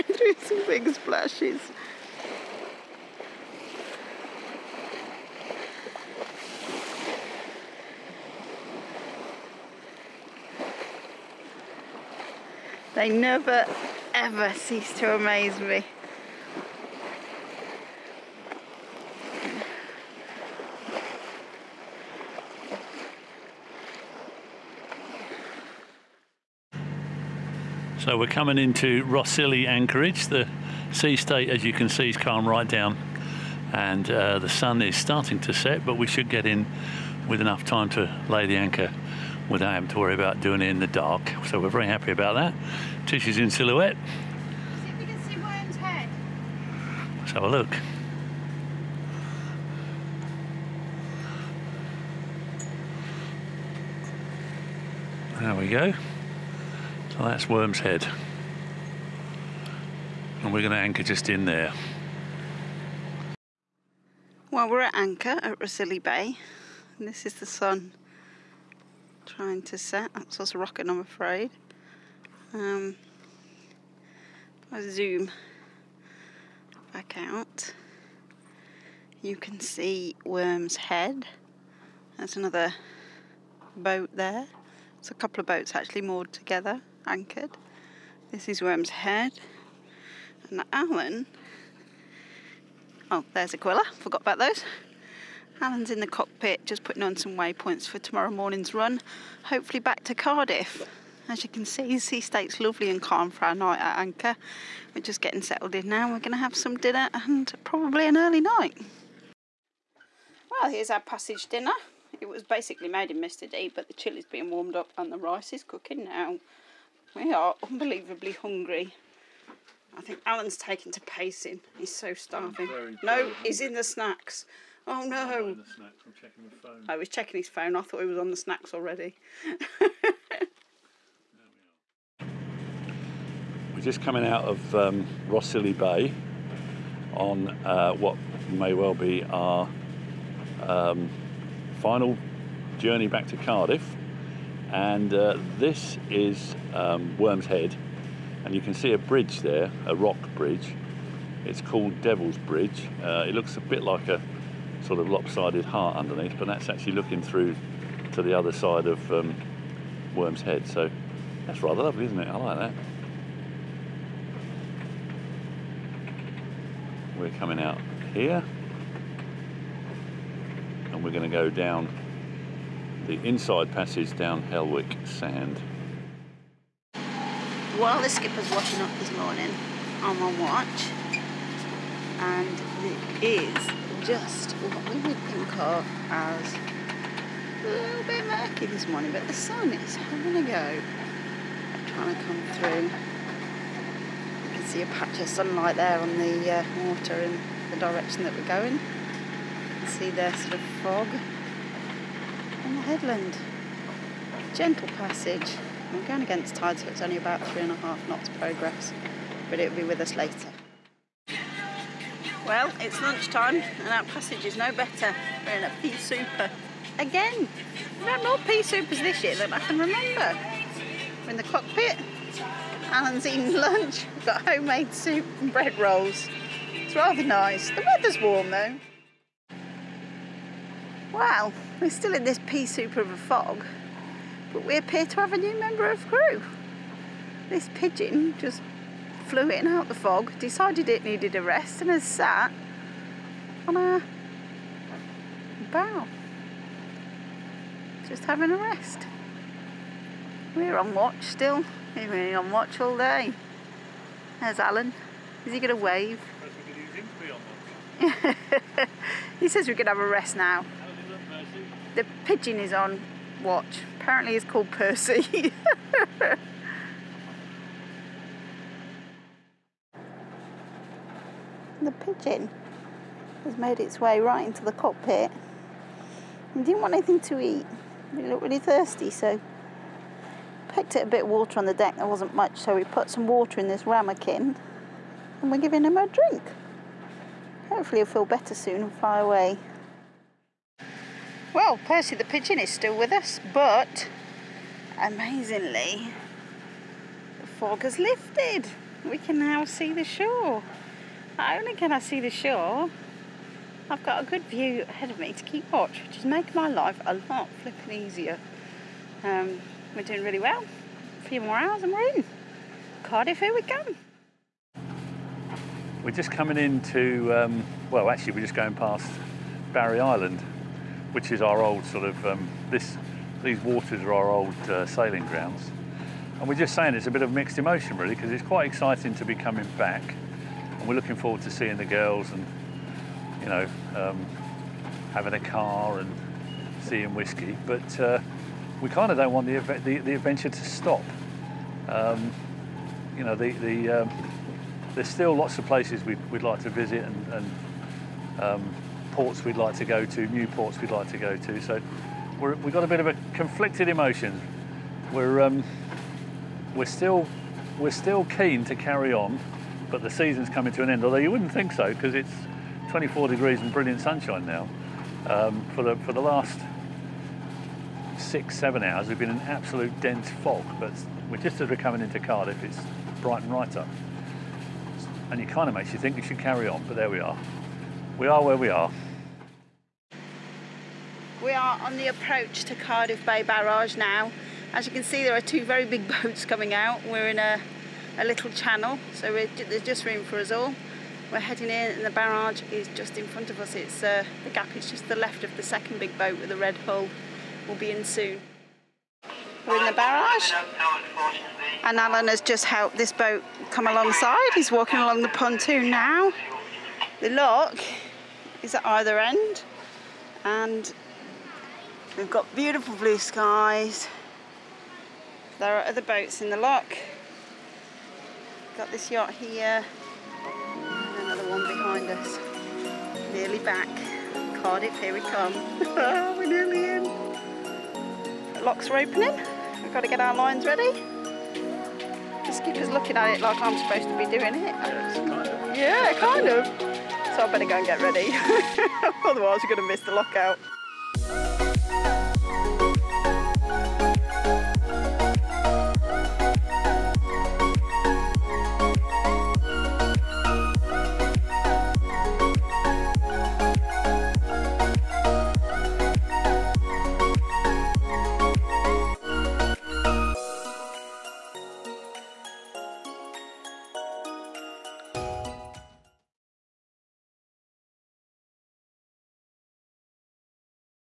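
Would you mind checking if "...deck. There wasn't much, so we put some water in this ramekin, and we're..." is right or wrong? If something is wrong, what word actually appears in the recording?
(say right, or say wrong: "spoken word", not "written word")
right.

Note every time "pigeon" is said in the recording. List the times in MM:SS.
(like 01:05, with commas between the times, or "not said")
03:57, 04:22, 04:31, 04:52.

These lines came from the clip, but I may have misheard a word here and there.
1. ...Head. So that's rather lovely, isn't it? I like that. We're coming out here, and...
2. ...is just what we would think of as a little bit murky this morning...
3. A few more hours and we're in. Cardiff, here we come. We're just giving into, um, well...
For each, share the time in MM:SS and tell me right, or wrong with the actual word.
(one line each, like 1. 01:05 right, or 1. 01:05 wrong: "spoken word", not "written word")
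1. 02:40 right
2. 03:03 right
3. 05:11 wrong: "coming", not "giving".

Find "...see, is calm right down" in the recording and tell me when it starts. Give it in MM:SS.
00:31.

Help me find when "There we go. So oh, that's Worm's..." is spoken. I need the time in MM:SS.
00:55.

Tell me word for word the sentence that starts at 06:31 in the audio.
We're heading in and the barrage is just in front of us.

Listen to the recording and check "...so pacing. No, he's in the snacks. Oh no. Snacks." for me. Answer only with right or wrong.
wrong.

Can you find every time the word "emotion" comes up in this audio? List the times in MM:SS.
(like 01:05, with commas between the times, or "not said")
05:27, 05:53.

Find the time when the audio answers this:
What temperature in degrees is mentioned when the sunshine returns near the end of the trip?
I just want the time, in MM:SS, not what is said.
06:02.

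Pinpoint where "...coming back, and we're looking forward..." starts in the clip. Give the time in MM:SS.
05:29.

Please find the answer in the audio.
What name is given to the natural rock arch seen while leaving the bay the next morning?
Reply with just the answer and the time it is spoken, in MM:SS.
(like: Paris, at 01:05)
Devil's Bridge, at 02:32.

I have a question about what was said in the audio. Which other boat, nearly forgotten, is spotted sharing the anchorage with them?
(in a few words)
Aquila.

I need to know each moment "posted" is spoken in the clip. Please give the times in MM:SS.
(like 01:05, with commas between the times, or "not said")
not said.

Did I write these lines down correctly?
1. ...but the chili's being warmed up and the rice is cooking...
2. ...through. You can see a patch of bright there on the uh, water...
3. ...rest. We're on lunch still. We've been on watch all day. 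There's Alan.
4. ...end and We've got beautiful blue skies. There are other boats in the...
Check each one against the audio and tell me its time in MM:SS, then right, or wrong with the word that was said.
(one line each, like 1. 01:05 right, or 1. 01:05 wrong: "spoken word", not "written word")
1. 01:53 right
2. 03:12 wrong: "sunlight", not "bright"
3. 04:08 wrong: "watch", not "lunch"
4. 06:49 right.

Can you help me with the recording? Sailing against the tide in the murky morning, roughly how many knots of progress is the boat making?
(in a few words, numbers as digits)
3.5 knots.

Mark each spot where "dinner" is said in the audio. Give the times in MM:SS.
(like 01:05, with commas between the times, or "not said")
01:46, 01:51.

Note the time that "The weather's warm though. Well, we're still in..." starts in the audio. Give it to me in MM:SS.
03:47.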